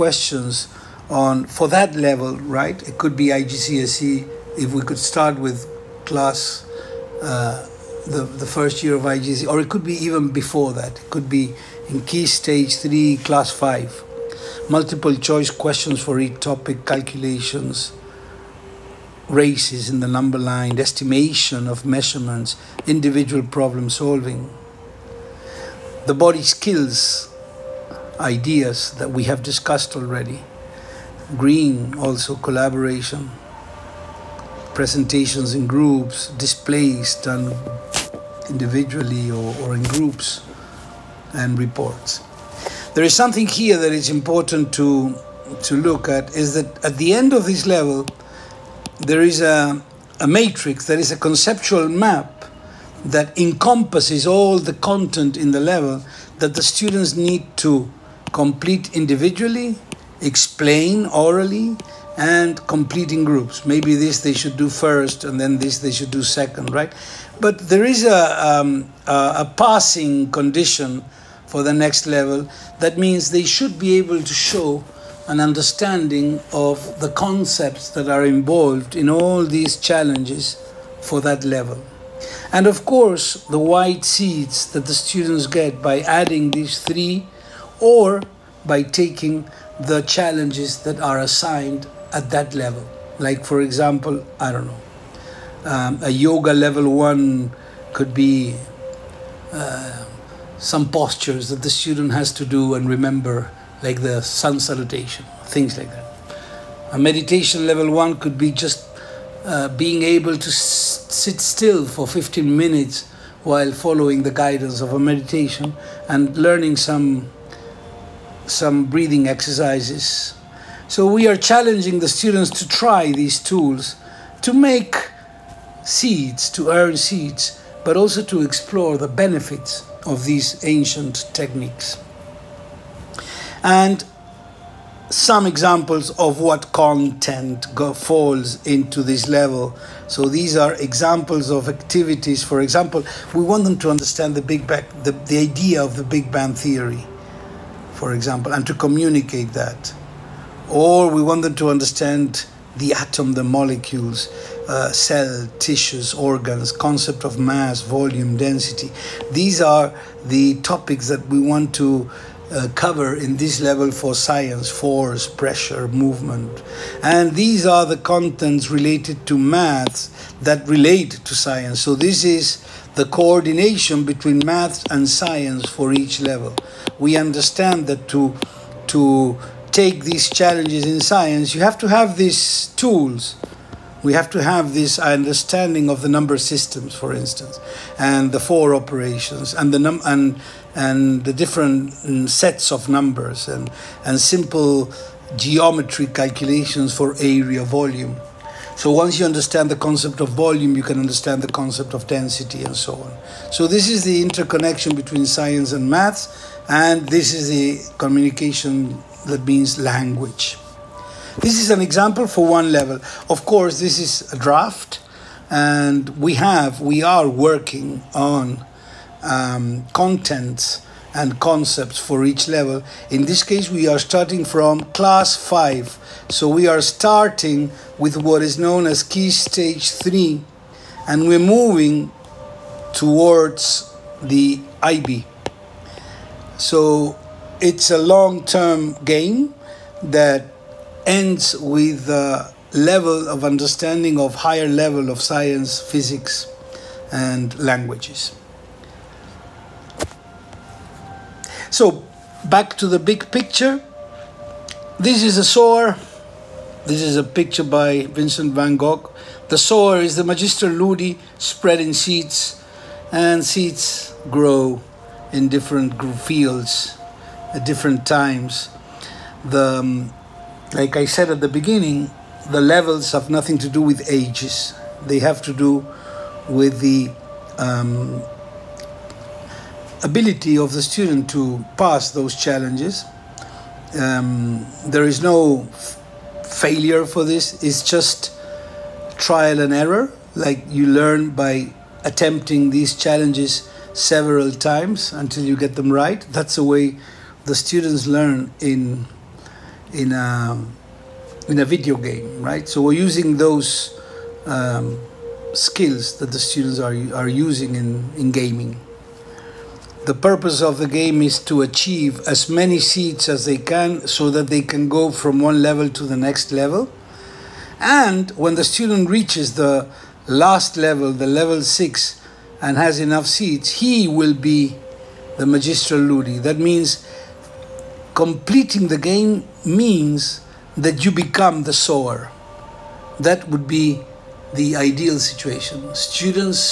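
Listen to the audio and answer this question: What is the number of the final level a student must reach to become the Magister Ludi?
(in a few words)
6.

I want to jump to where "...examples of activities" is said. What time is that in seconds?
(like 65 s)
140 s.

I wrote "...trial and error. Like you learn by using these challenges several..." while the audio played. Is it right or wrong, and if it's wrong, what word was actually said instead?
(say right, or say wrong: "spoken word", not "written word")
wrong: "attempting", not "using".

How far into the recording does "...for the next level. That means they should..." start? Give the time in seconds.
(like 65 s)
71 s.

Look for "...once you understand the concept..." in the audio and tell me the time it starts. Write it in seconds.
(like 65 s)
198 s.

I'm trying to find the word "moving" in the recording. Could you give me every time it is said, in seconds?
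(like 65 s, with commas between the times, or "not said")
231 s.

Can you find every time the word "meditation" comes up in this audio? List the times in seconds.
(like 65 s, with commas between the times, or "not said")
106 s, 114 s.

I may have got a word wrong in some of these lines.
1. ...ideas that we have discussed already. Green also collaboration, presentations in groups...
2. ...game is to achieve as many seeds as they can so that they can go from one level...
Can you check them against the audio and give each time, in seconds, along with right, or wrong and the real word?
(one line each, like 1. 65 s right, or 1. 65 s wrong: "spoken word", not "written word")
1. 28 s right
2. 310 s right.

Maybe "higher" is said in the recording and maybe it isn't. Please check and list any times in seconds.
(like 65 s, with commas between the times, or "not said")
244 s.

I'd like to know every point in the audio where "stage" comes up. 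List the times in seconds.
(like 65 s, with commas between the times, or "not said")
12 s, 229 s.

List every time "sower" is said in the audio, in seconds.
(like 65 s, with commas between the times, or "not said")
255 s, 259 s, 331 s.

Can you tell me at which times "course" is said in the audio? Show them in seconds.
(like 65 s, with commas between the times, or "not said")
82 s, 213 s.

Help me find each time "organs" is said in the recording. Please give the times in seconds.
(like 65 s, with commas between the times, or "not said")
156 s.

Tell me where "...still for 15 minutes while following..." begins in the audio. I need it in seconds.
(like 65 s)
111 s.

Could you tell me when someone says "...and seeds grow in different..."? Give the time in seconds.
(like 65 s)
263 s.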